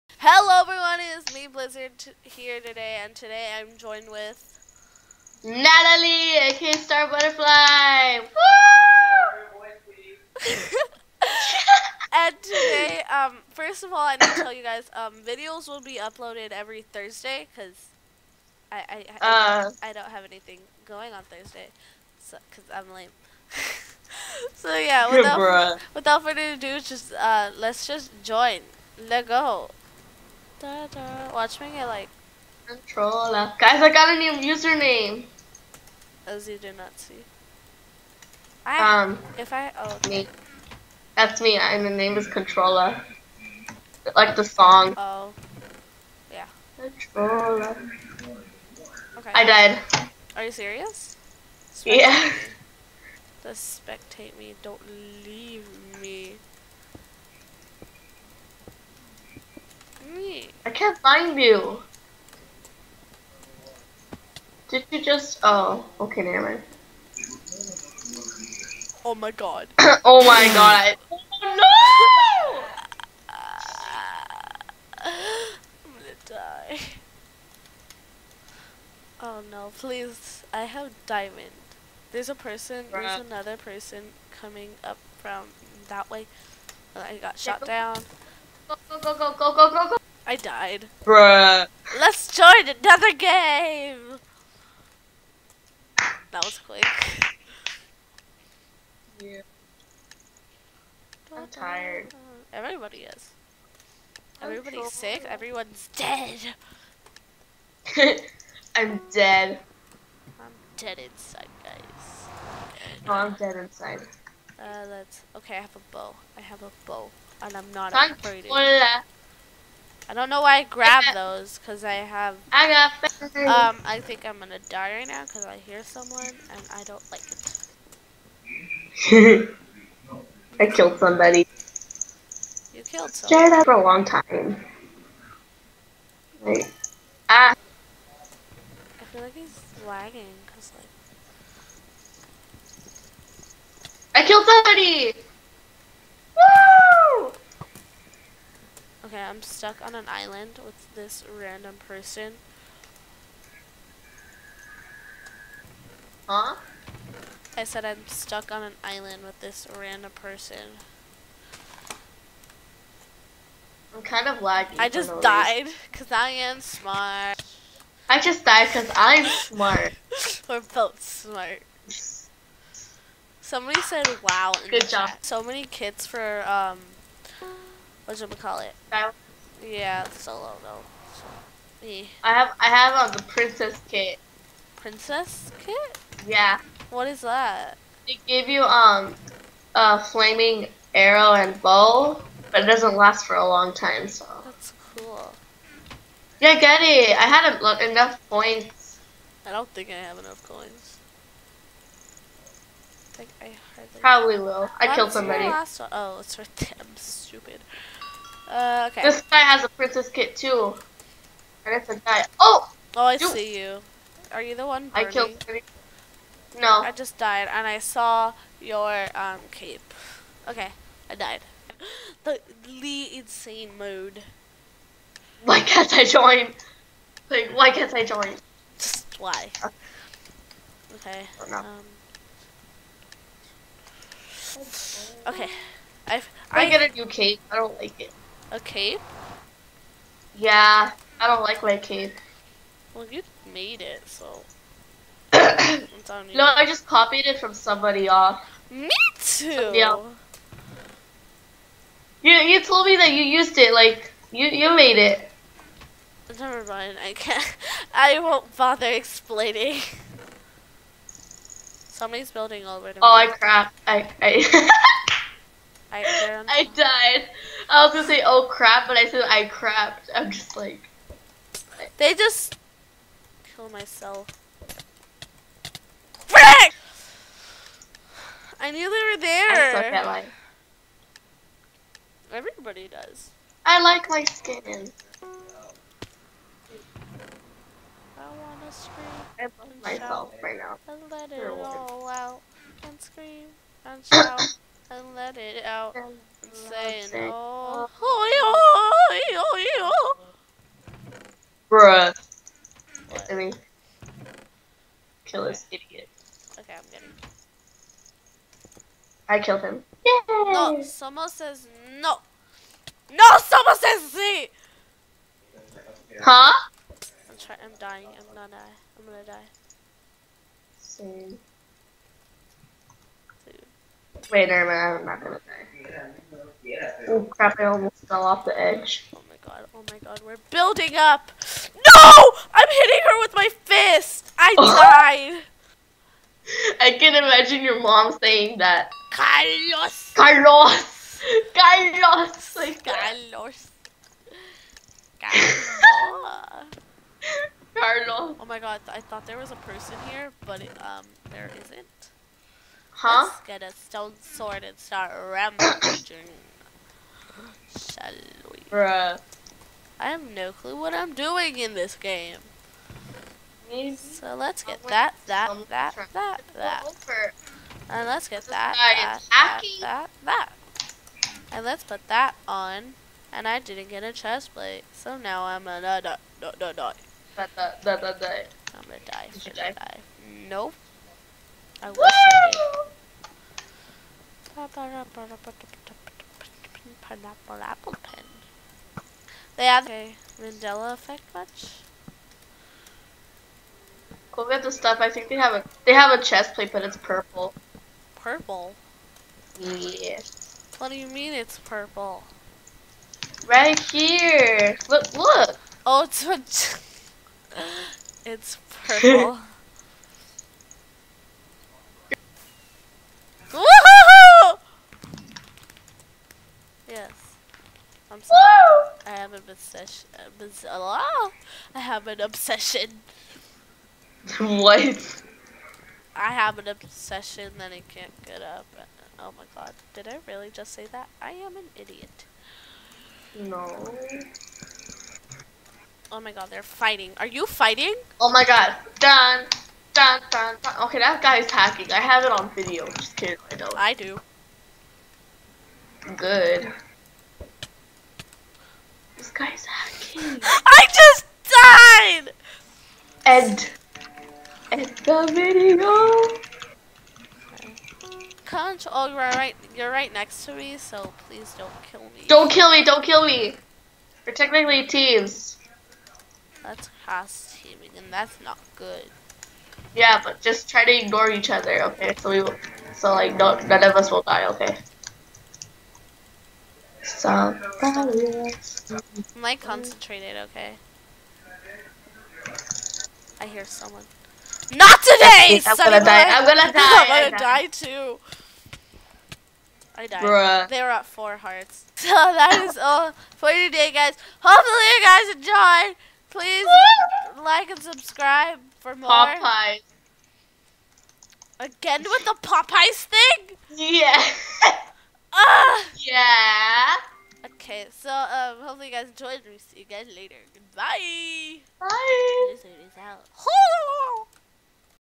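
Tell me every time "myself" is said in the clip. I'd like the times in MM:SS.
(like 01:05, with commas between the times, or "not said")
04:33, 04:49.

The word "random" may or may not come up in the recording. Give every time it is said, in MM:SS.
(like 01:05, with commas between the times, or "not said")
02:31, 02:39.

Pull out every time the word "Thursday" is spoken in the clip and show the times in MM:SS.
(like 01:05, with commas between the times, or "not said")
00:16, 00:21.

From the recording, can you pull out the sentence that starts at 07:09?
Did I really just say that?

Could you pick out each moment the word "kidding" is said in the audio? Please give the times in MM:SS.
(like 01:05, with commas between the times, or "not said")
07:23.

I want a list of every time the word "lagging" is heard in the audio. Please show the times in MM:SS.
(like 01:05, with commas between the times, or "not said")
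02:19, 02:44.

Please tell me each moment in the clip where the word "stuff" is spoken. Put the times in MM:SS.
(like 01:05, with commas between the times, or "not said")
06:34.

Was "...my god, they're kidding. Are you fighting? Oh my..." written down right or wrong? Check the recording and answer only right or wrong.
wrong.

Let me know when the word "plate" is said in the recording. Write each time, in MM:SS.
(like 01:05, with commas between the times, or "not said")
06:14, 06:36.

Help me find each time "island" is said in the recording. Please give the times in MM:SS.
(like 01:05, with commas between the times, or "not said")
02:30, 02:38.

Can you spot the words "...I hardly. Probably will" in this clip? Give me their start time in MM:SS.
03:23.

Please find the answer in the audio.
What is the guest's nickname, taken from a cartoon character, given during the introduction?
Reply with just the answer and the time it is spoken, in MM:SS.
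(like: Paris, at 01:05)
Star Butterfly, at 00:06.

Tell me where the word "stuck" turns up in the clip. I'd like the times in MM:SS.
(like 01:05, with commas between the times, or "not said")
02:29, 02:38.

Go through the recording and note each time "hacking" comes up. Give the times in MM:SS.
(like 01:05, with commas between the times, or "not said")
07:21, 07:29.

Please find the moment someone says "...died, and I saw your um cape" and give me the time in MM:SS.
03:37.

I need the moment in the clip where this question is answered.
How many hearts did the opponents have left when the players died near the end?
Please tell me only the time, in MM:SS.
08:11.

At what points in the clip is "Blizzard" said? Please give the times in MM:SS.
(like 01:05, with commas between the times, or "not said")
00:01.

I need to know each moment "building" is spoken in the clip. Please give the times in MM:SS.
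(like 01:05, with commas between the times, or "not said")
04:22, 05:30.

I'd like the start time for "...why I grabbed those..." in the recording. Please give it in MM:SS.
02:00.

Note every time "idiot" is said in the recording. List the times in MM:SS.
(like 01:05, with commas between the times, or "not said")
05:05, 07:11.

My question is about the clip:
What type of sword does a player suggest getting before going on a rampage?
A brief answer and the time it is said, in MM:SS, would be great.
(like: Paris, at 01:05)
Stone sword, at 05:53.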